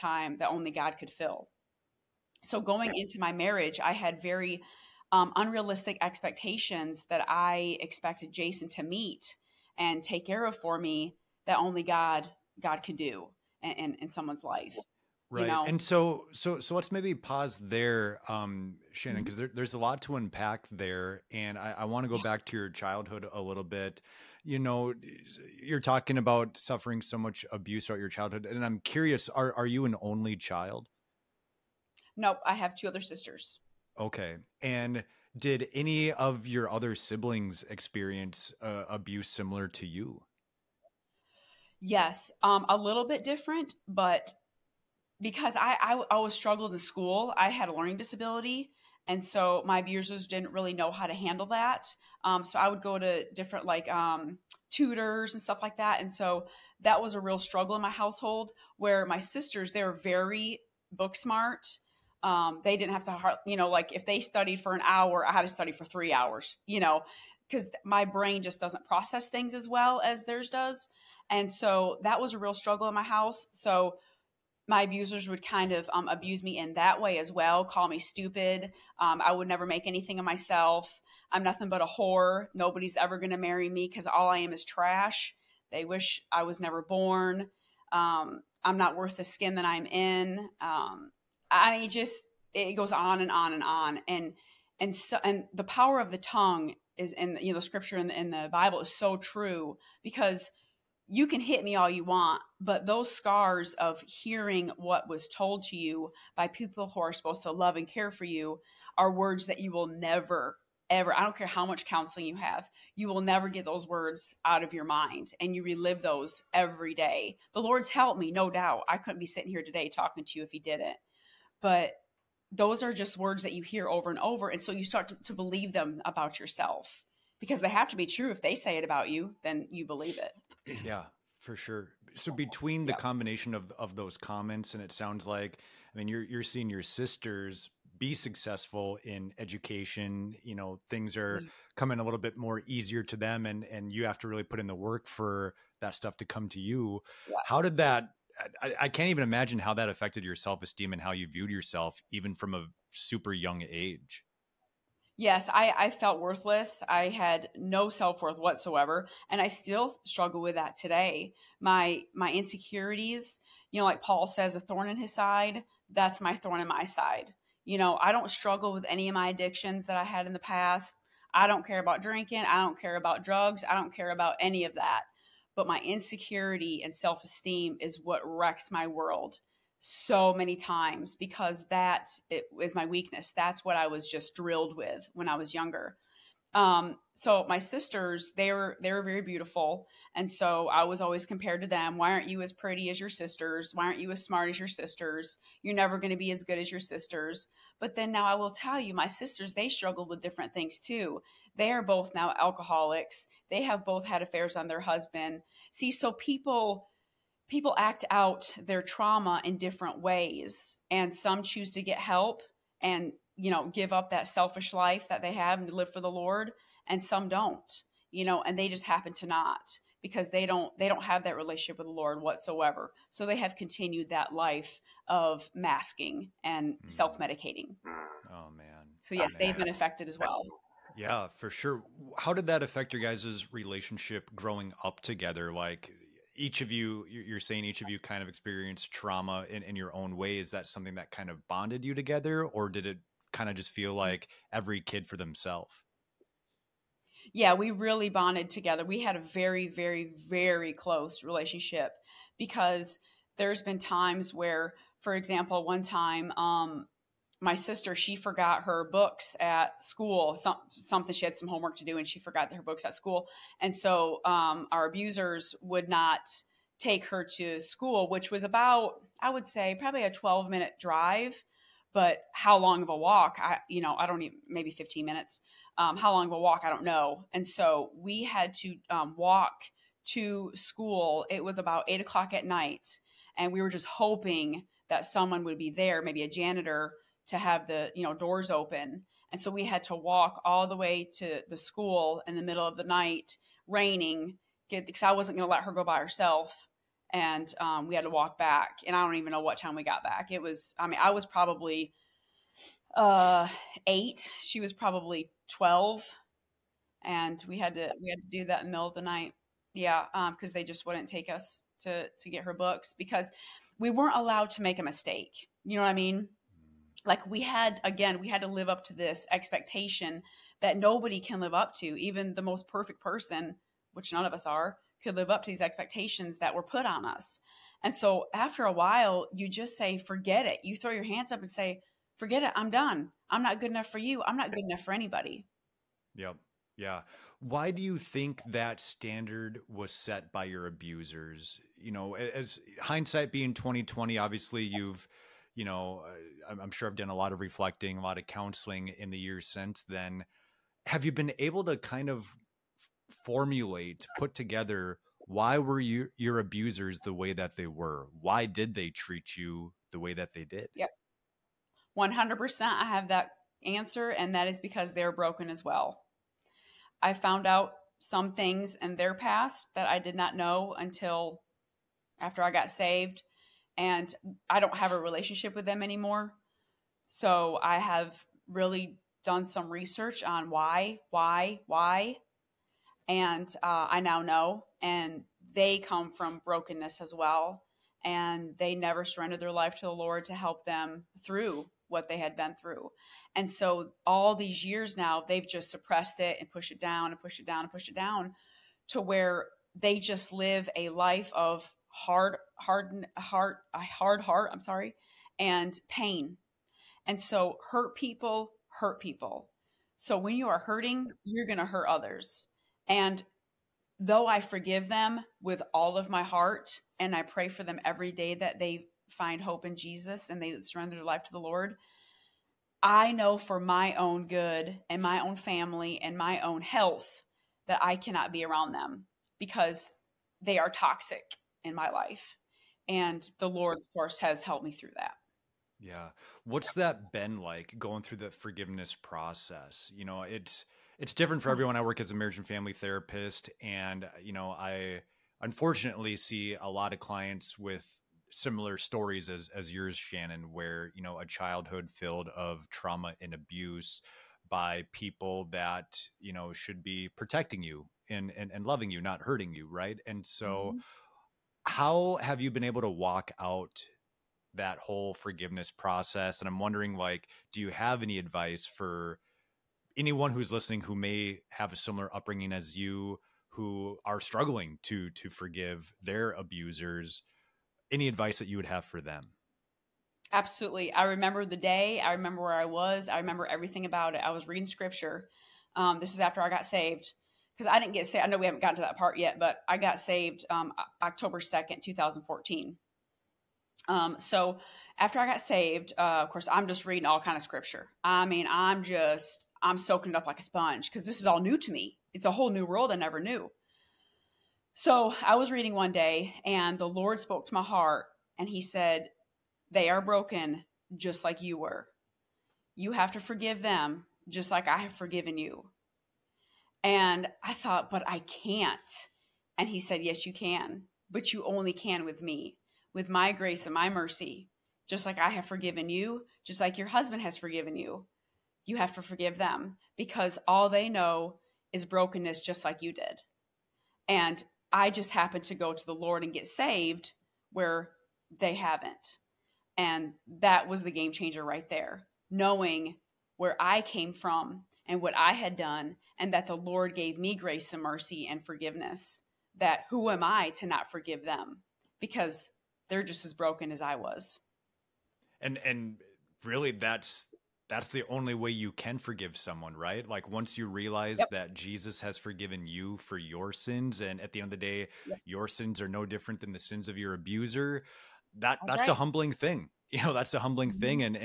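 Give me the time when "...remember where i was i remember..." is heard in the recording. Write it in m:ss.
8:02.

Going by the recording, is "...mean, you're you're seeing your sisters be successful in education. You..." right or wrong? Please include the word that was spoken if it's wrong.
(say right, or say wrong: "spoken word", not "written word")
right.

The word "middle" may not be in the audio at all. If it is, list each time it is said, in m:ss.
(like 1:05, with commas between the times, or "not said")
4:52, 5:08.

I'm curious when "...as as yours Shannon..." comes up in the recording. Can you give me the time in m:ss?
7:29.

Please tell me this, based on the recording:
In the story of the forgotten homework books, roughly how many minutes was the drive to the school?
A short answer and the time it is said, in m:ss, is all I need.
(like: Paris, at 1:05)
12 minutes, at 4:30.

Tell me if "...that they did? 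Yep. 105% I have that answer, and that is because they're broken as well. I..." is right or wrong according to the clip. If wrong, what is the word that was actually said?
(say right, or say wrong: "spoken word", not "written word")
wrong: "100", not "105".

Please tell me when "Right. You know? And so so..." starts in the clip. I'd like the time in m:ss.
0:15.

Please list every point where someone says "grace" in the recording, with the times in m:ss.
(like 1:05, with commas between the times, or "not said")
8:43, 9:07.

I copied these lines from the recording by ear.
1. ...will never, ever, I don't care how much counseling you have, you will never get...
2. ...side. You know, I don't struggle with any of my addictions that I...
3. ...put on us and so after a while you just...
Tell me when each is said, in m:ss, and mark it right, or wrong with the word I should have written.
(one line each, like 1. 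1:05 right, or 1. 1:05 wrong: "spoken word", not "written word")
1. 1:49 right
2. 2:46 right
3. 5:26 right.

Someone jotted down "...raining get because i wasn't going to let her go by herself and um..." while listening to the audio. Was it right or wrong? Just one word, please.
right.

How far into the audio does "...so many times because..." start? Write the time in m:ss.
2:59.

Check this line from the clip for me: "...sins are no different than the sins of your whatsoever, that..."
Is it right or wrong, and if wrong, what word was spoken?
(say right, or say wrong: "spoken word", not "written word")
wrong: "abuser", not "whatsoever".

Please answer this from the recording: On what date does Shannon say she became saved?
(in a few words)
October 2, 2014.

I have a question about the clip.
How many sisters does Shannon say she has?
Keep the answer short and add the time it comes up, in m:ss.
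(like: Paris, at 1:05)
2, at 0:32.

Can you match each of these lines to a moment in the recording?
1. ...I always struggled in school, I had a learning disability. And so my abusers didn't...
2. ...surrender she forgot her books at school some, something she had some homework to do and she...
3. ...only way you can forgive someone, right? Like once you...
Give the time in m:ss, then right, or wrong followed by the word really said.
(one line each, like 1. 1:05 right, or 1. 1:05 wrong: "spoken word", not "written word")
1. 0:45 right
2. 4:17 wrong: "sister", not "surrender"
3. 9:18 right.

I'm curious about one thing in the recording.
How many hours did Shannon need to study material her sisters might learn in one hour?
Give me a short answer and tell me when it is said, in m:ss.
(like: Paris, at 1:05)
3 hours, at 1:05.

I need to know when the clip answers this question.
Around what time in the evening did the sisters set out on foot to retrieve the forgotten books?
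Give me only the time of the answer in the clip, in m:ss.
4:41.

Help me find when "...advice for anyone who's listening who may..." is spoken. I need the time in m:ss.
7:48.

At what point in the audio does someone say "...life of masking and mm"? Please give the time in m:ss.
3:44.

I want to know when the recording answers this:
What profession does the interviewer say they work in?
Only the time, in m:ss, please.
7:22.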